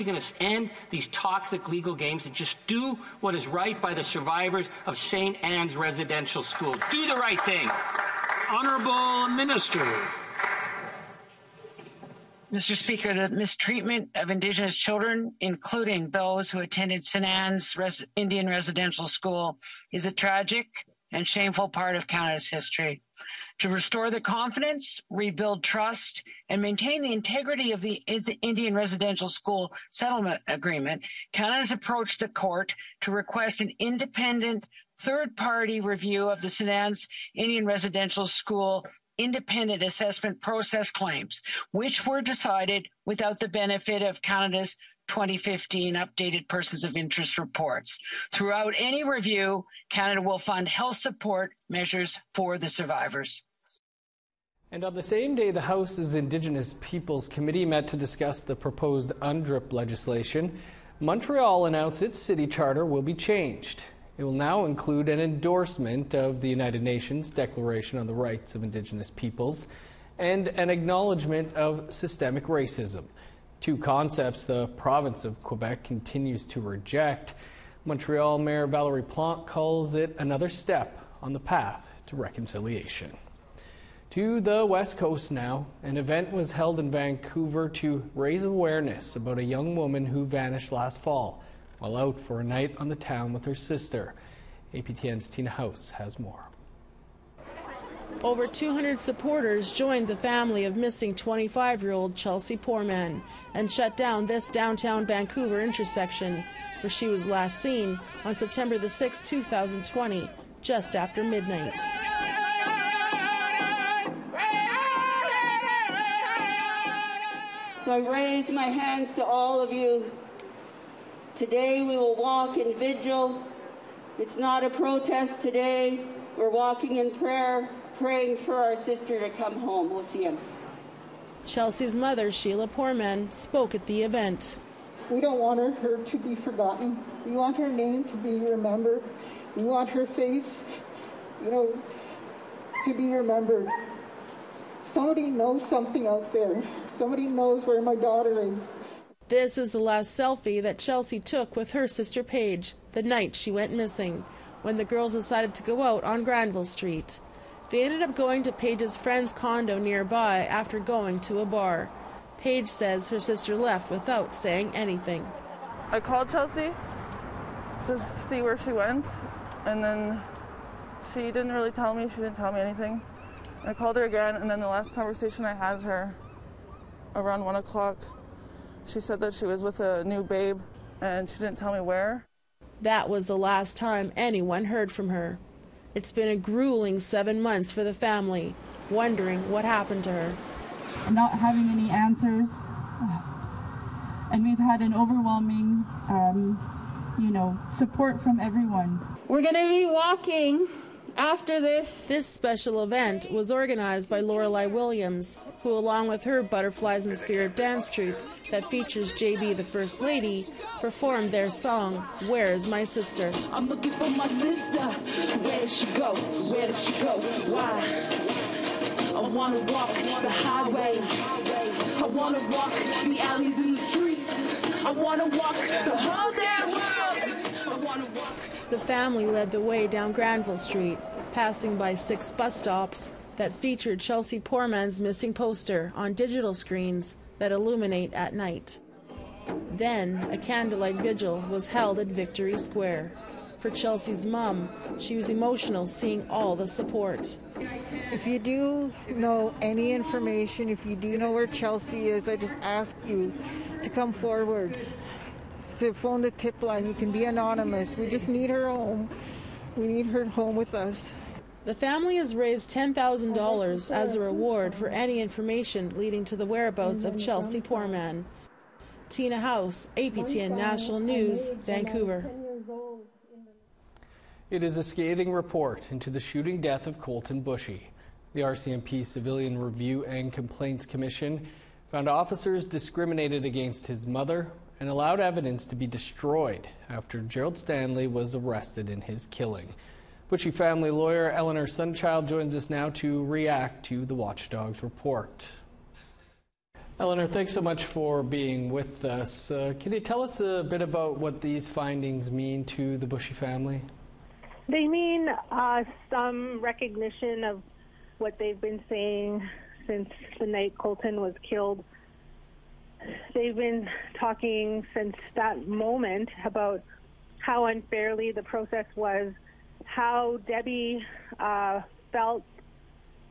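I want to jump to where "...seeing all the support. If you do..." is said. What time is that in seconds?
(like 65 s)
245 s.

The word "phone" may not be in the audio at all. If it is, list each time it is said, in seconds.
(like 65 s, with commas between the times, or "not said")
255 s.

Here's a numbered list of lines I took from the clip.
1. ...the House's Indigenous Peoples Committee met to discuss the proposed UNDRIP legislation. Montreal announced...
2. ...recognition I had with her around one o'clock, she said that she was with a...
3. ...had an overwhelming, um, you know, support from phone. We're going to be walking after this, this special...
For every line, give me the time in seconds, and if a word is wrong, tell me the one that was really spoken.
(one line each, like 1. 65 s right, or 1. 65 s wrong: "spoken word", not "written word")
1. 55 s right
2. 174 s wrong: "conversation", not "recognition"
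3. 194 s wrong: "everyone", not "phone".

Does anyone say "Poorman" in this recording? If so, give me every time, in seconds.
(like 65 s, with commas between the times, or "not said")
102 s, 132 s, 234 s, 267 s.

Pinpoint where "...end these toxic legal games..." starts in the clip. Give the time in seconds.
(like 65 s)
0 s.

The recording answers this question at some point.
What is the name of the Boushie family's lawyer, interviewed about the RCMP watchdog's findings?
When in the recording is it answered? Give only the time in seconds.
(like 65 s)
291 s.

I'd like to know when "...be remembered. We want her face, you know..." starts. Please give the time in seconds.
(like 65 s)
138 s.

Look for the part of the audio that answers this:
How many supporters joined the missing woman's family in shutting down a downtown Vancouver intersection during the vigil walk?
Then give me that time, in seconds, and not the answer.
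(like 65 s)
98 s.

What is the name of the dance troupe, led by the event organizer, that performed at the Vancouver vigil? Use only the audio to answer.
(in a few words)
Butterflies in Spirit.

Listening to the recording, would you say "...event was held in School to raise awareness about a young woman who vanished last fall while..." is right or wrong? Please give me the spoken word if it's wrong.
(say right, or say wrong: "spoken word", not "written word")
wrong: "Vancouver", not "School".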